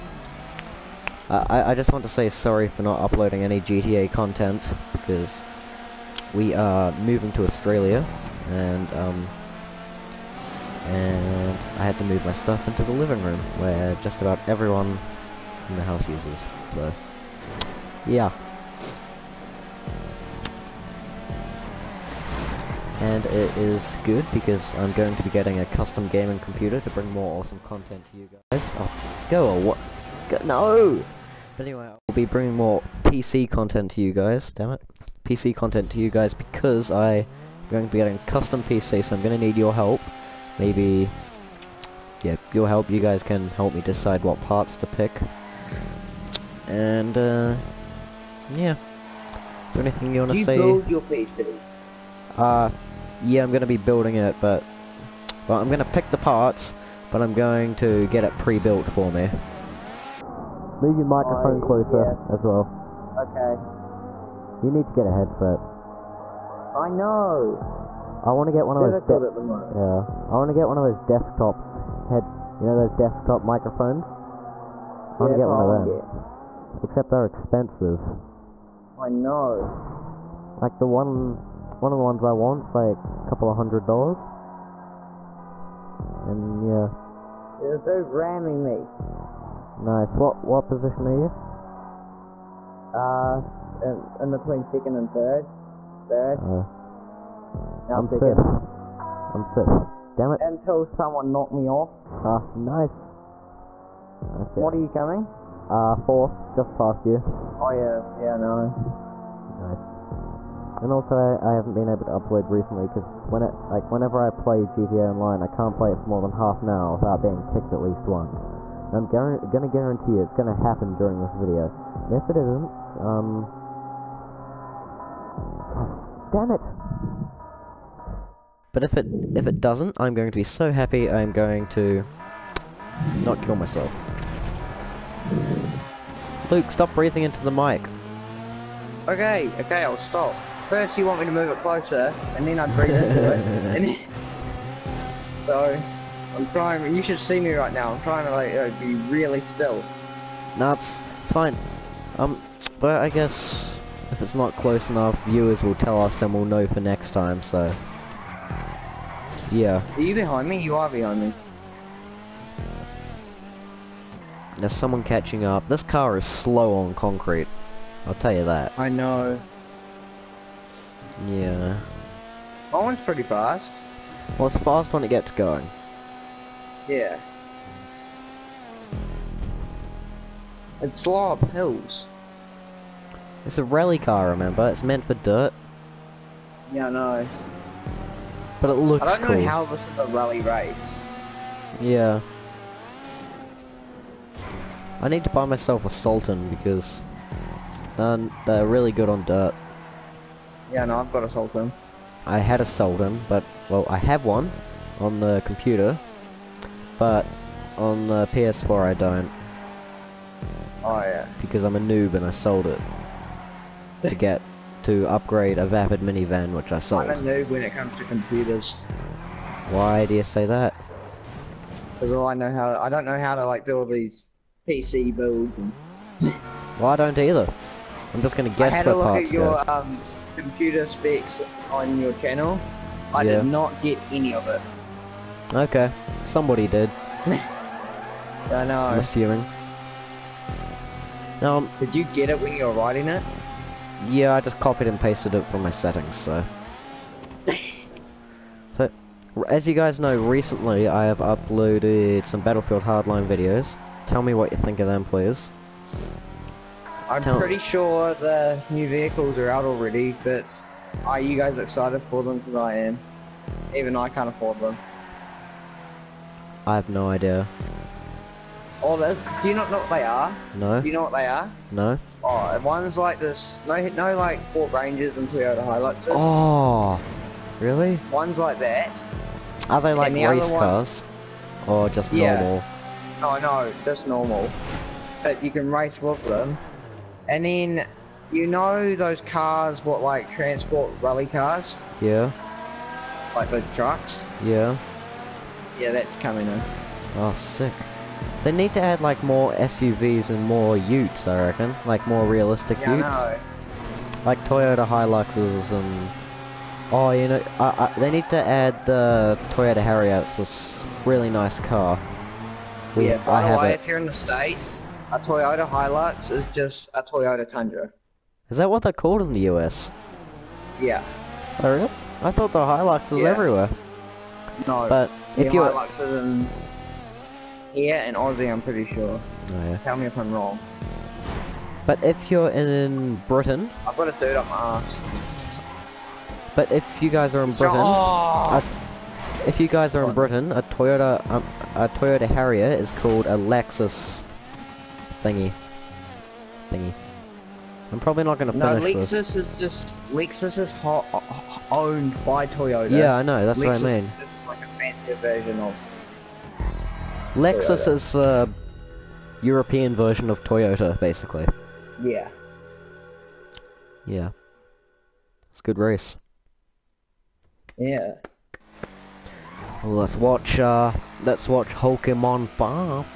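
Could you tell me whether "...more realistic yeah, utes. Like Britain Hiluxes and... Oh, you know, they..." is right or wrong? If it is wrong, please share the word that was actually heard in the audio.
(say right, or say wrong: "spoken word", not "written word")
wrong: "Toyota", not "Britain".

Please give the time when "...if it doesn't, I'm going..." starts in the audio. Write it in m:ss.
2:09.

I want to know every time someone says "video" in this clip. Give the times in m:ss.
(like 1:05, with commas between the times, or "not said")
2:01, 4:13.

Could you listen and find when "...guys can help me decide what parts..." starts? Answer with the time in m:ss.
0:42.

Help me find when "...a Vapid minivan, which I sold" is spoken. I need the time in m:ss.
3:35.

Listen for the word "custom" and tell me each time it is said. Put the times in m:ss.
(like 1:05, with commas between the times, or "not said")
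0:25, 0:38.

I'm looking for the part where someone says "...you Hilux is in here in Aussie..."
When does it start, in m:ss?
5:25.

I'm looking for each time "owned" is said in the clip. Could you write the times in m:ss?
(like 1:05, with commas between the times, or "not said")
5:51.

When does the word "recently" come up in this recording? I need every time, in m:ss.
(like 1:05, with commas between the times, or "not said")
1:52, 4:10.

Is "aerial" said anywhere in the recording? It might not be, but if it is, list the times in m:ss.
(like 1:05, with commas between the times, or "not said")
not said.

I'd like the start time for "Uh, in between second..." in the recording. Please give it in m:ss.
1:32.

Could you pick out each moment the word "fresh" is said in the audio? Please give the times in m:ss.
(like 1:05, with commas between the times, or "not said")
not said.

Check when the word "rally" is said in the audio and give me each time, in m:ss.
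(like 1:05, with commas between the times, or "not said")
3:03, 3:10, 4:50.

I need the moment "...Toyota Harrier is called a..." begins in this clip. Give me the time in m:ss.
5:41.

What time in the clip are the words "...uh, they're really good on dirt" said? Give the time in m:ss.
3:17.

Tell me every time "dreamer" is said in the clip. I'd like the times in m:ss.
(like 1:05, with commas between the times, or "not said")
not said.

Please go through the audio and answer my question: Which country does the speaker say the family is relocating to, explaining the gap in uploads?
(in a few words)
Australia.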